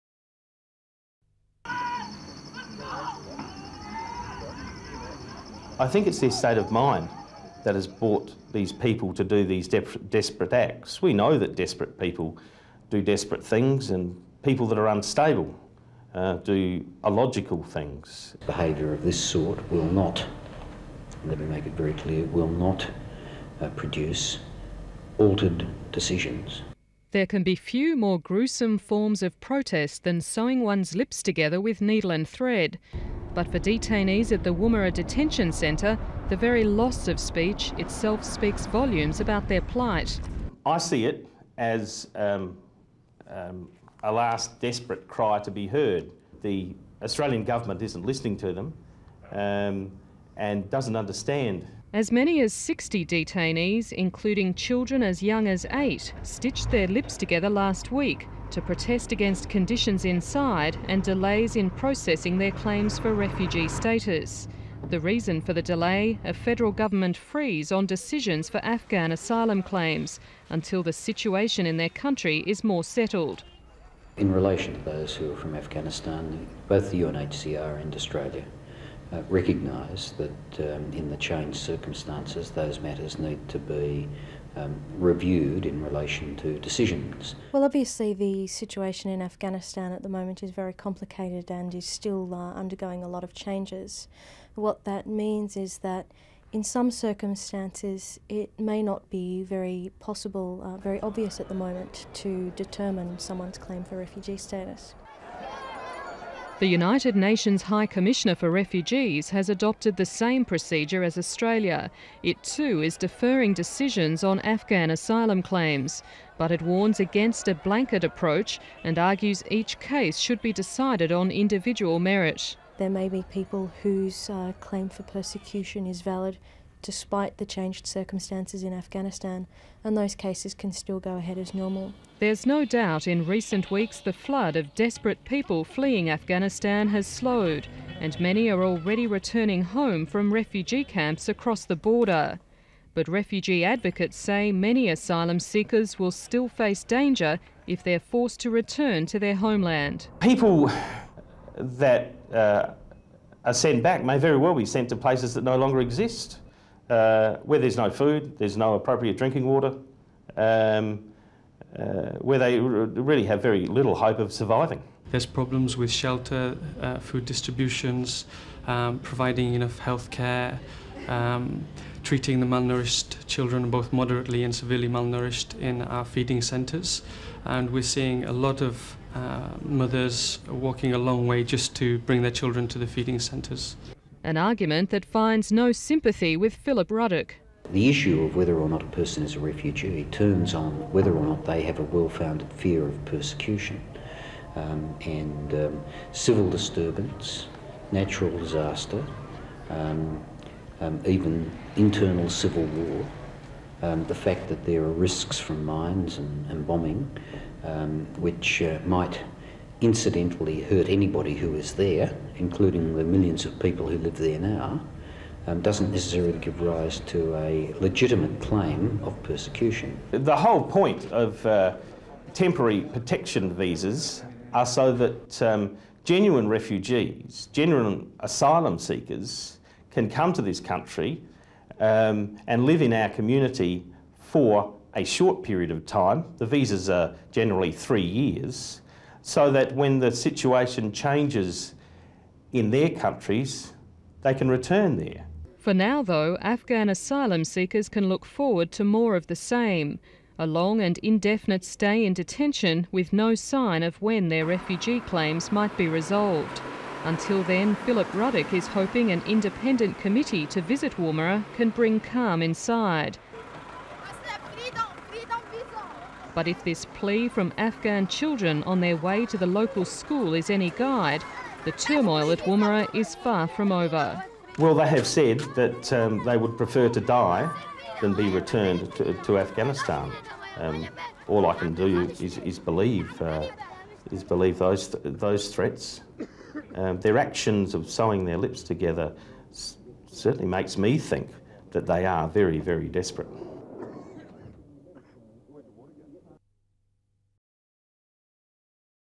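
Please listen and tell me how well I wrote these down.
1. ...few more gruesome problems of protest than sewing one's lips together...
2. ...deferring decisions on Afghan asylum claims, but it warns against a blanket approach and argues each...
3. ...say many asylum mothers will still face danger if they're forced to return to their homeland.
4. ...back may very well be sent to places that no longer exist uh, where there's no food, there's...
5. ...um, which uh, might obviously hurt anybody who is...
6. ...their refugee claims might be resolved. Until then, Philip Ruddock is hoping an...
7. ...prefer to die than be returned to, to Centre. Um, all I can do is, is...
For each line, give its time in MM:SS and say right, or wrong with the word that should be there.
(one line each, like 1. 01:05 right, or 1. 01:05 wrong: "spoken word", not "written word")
1. 00:27 wrong: "forms", not "problems"
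2. 01:52 right
3. 02:24 wrong: "seekers", not "mothers"
4. 02:33 right
5. 03:27 wrong: "incidentally", not "obviously"
6. 04:14 right
7. 04:36 wrong: "Afghanistan", not "Centre".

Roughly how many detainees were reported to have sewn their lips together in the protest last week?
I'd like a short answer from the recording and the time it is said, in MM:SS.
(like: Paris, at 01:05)
60, at 00:52.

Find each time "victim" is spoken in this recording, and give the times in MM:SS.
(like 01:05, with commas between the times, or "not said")
not said.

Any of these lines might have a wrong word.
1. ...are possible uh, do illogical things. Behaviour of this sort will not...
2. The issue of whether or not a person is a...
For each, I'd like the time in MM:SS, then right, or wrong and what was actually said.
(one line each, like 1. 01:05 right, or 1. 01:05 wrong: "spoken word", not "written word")
1. 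00:14 wrong: "unstable", not "possible"
2. 03:07 right.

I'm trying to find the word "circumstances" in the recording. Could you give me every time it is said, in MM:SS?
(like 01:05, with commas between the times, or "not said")
01:21, 01:36, 02:07.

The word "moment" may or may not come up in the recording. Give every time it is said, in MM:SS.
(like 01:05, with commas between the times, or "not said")
01:30, 01:41.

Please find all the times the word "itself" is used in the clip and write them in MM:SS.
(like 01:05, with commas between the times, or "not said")
00:37.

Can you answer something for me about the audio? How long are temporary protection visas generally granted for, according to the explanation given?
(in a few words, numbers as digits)
3 years.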